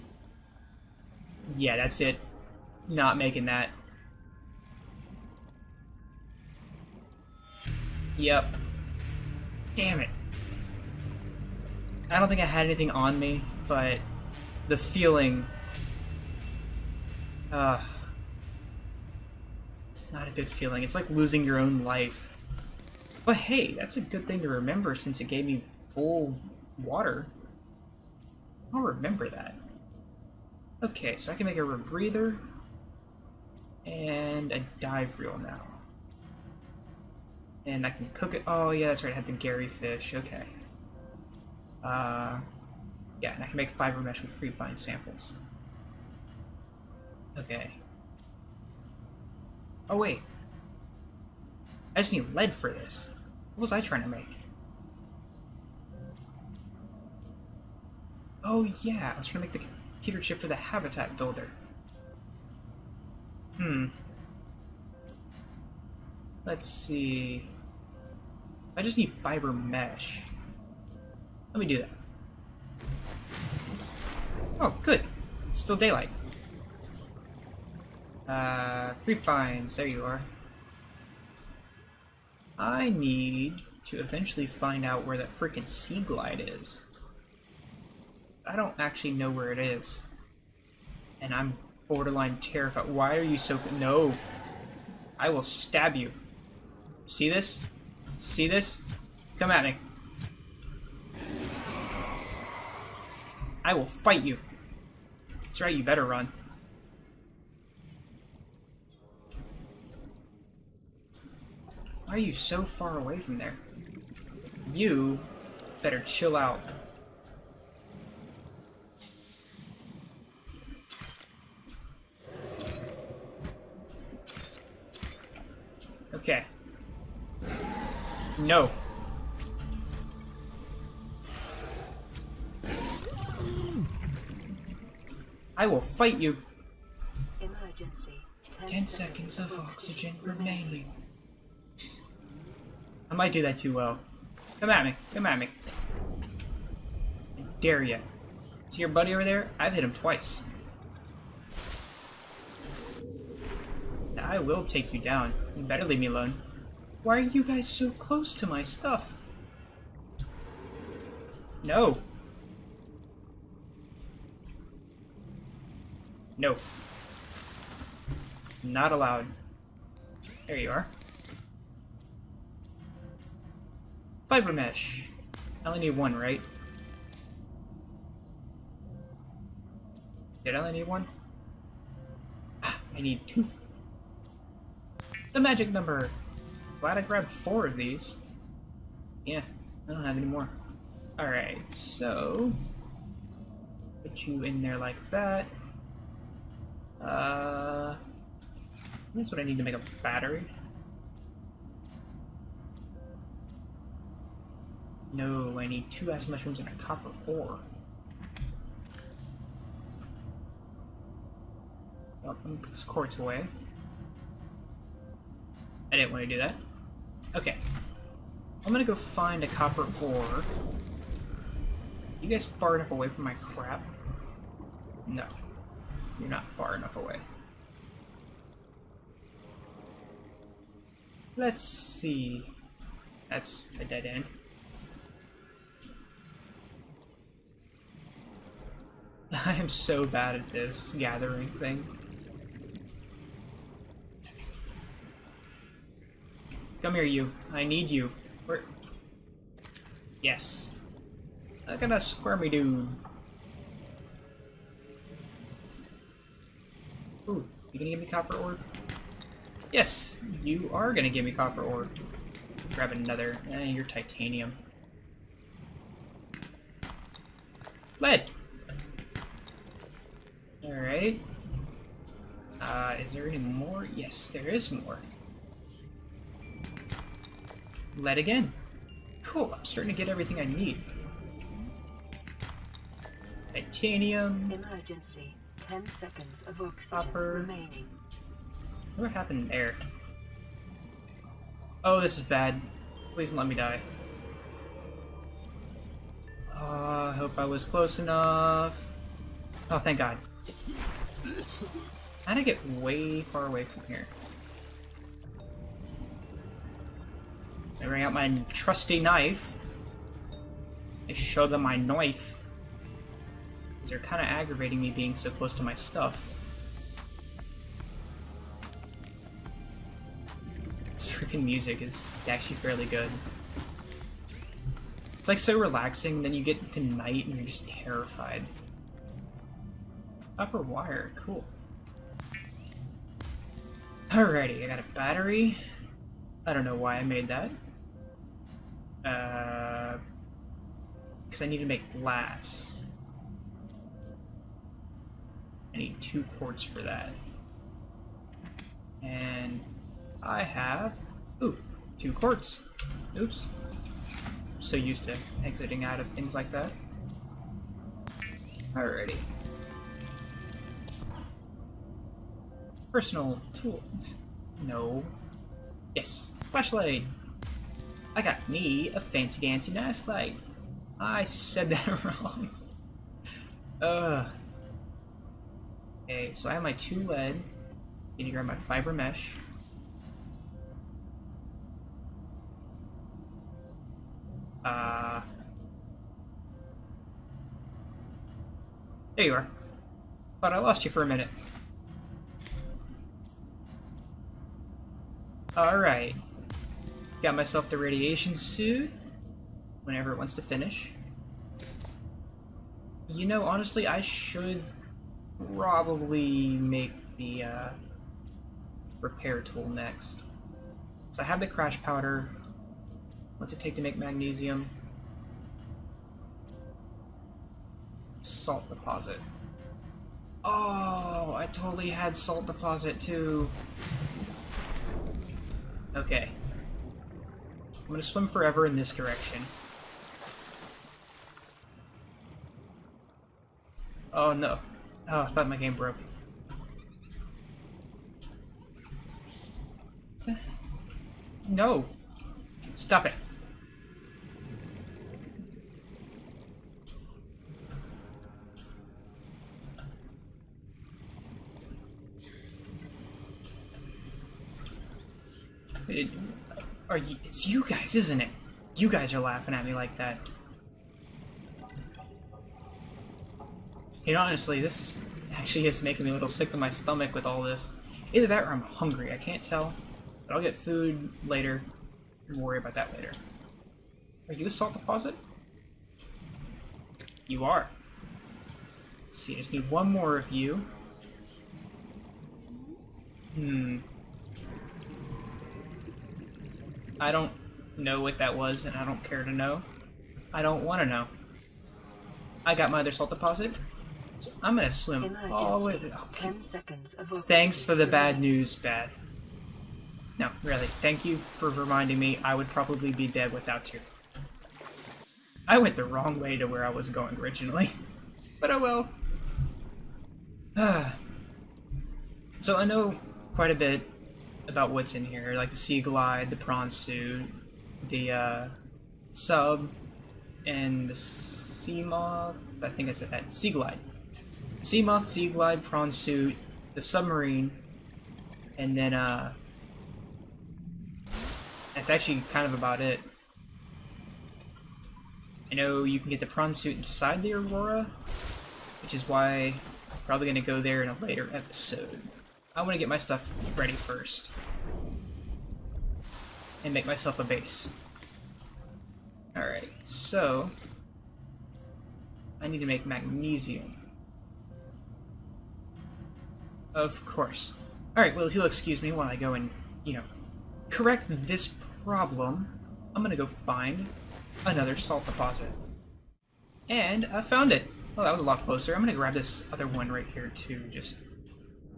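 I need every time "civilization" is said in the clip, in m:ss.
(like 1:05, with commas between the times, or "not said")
not said.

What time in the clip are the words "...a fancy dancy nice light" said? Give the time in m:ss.
6:08.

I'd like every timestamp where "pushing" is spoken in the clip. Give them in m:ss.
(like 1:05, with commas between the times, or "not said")
not said.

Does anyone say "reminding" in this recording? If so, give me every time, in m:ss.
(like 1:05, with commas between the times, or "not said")
8:21.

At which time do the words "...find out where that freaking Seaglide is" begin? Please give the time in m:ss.
1:24.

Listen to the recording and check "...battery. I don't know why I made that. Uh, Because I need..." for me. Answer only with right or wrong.
right.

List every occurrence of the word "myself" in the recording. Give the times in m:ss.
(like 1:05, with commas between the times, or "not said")
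6:37, 9:06.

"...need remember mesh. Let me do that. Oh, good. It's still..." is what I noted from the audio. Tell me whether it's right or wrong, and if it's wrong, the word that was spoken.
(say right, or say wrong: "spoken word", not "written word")
wrong: "fiber", not "remember".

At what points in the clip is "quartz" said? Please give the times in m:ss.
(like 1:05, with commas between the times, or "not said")
3:32, 5:46, 5:52.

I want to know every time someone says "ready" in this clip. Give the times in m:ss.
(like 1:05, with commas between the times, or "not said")
9:03.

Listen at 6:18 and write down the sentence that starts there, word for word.
Need to grab my fiber mesh.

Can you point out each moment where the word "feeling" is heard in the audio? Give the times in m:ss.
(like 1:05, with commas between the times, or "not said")
0:14, 0:20.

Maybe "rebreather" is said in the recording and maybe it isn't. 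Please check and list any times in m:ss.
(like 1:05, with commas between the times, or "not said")
0:31.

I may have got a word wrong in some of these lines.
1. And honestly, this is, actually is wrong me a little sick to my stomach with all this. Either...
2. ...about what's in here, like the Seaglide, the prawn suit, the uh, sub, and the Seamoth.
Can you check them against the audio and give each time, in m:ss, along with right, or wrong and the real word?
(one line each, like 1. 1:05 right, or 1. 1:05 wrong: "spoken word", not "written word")
1. 7:44 wrong: "making", not "wrong"
2. 8:34 right.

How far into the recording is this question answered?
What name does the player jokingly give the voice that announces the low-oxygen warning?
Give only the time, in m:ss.
8:18.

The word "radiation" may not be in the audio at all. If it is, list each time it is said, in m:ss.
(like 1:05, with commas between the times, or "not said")
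6:37.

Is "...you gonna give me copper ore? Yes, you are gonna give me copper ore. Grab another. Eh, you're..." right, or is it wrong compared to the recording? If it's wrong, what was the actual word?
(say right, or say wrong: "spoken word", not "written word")
right.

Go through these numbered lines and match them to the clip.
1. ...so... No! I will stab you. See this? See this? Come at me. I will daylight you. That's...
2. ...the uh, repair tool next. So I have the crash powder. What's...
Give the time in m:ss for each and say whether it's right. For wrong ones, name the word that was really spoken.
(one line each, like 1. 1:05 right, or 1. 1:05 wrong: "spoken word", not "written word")
1. 1:33 wrong: "fight", not "daylight"
2. 6:47 right.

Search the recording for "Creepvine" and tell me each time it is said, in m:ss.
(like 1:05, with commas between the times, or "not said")
0:44, 1:19.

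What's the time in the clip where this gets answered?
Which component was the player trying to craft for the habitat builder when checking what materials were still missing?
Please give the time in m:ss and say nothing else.
1:00.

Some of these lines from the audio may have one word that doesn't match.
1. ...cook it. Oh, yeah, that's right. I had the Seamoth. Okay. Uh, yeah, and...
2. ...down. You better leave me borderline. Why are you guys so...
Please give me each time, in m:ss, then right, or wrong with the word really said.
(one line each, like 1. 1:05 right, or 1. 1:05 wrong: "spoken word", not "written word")
1. 0:38 wrong: "Garryfish", not "Seamoth"
2. 2:35 wrong: "alone", not "borderline".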